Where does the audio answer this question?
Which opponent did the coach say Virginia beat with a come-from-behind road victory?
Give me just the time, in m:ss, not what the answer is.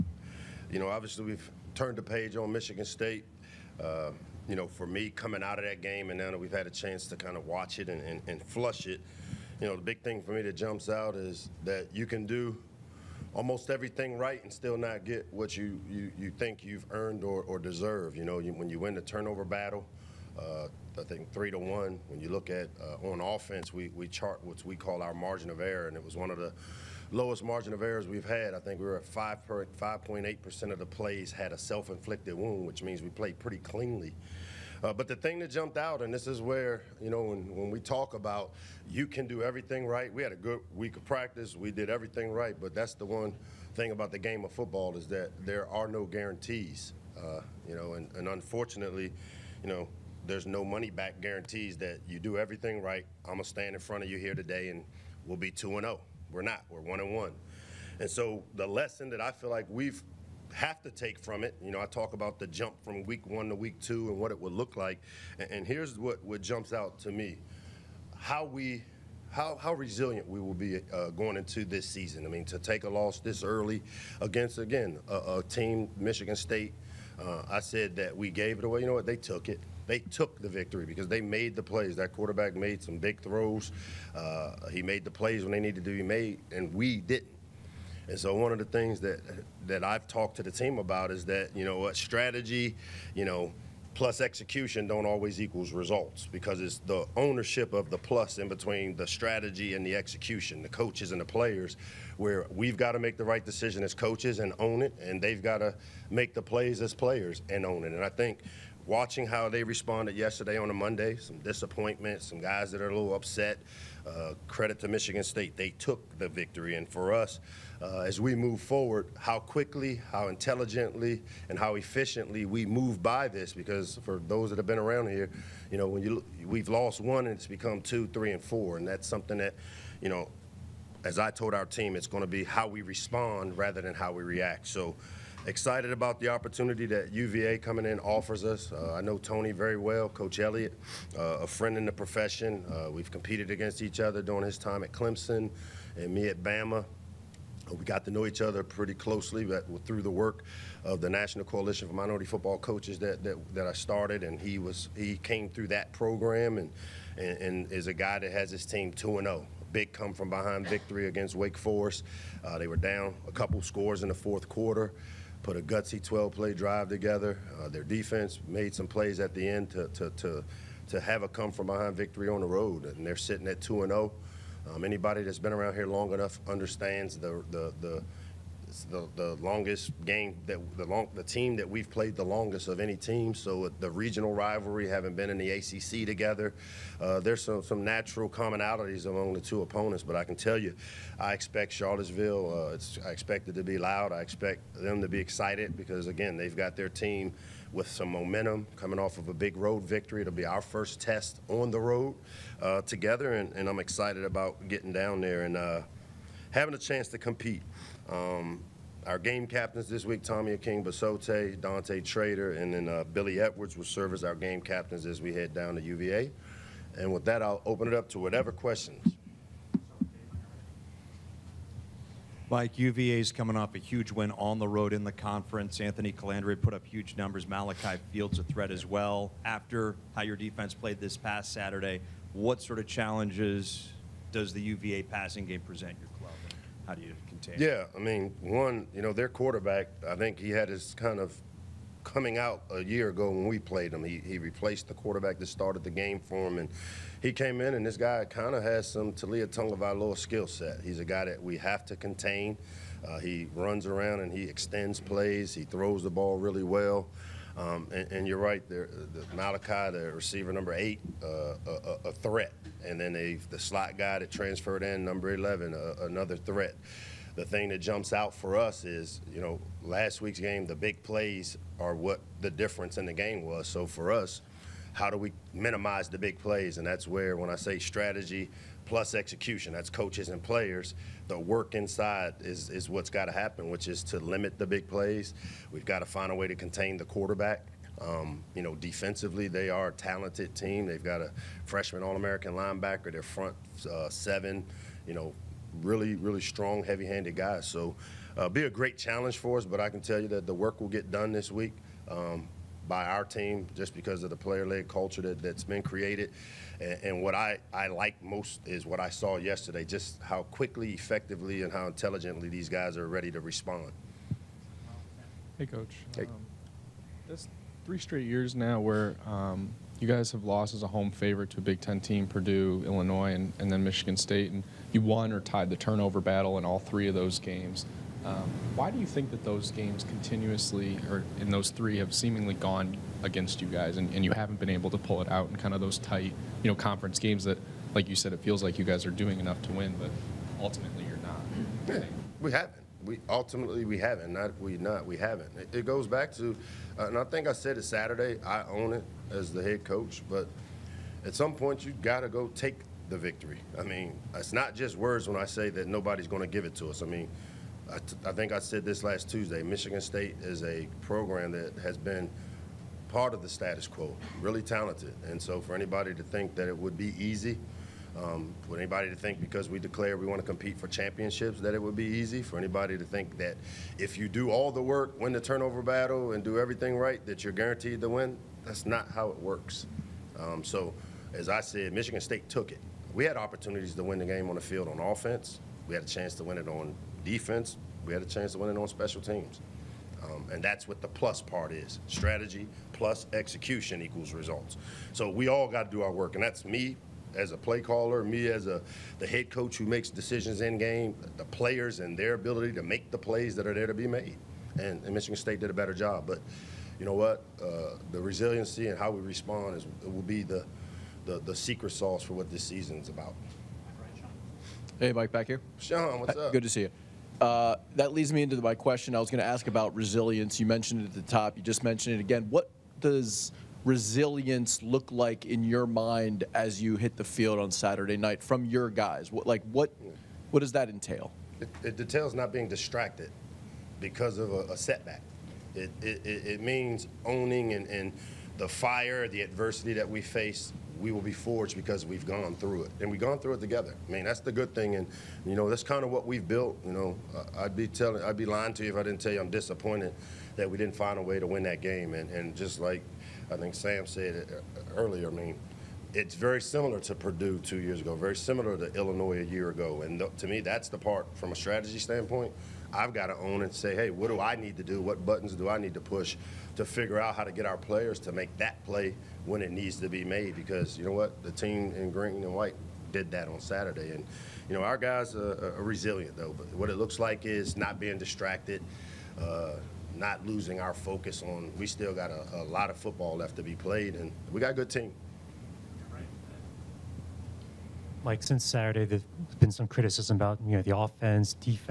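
2:41.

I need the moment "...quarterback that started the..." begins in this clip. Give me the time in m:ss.
4:04.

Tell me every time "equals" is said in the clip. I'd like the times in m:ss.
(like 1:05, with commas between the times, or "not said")
1:35, 6:34.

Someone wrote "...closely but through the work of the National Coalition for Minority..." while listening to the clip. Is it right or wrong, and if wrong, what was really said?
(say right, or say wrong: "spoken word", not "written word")
right.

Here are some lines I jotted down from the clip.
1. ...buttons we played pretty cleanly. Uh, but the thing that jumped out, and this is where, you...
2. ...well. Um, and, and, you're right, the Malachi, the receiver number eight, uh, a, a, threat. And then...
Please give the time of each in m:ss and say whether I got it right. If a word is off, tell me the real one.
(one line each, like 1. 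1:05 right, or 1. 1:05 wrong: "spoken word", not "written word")
1. 0:32 wrong: "means", not "buttons"
2. 4:16 right.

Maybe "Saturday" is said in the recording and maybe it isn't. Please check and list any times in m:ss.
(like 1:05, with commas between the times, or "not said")
3:51, 5:47, 7:07, 7:53, 8:08.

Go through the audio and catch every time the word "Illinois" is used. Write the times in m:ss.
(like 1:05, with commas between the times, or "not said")
5:22, 7:38.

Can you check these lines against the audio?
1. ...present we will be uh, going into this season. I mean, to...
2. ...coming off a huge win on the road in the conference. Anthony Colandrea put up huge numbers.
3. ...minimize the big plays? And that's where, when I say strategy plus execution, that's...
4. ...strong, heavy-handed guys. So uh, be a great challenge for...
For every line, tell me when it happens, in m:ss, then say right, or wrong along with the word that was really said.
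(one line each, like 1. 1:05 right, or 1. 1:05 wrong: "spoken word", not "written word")
1. 1:09 wrong: "resilient", not "present"
2. 3:43 right
3. 4:35 right
4. 4:56 right.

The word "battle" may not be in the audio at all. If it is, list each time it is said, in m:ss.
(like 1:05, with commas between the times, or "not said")
0:19, 5:26, 6:15.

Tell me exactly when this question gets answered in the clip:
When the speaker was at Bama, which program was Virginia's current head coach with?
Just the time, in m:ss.
2:24.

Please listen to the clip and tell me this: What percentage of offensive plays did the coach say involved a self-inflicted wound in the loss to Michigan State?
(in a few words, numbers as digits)
5.8%.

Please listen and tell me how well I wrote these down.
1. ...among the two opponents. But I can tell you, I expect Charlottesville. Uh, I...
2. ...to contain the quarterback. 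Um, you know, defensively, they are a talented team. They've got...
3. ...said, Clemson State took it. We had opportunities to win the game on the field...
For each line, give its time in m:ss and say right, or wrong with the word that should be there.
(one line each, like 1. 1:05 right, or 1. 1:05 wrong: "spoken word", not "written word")
1. 3:09 right
2. 4:46 right
3. 6:21 wrong: "Michigan", not "Clemson".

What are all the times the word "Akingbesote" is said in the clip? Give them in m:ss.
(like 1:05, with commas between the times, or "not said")
3:30.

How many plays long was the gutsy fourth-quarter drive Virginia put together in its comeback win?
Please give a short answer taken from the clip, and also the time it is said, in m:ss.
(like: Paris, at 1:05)
12, at 2:46.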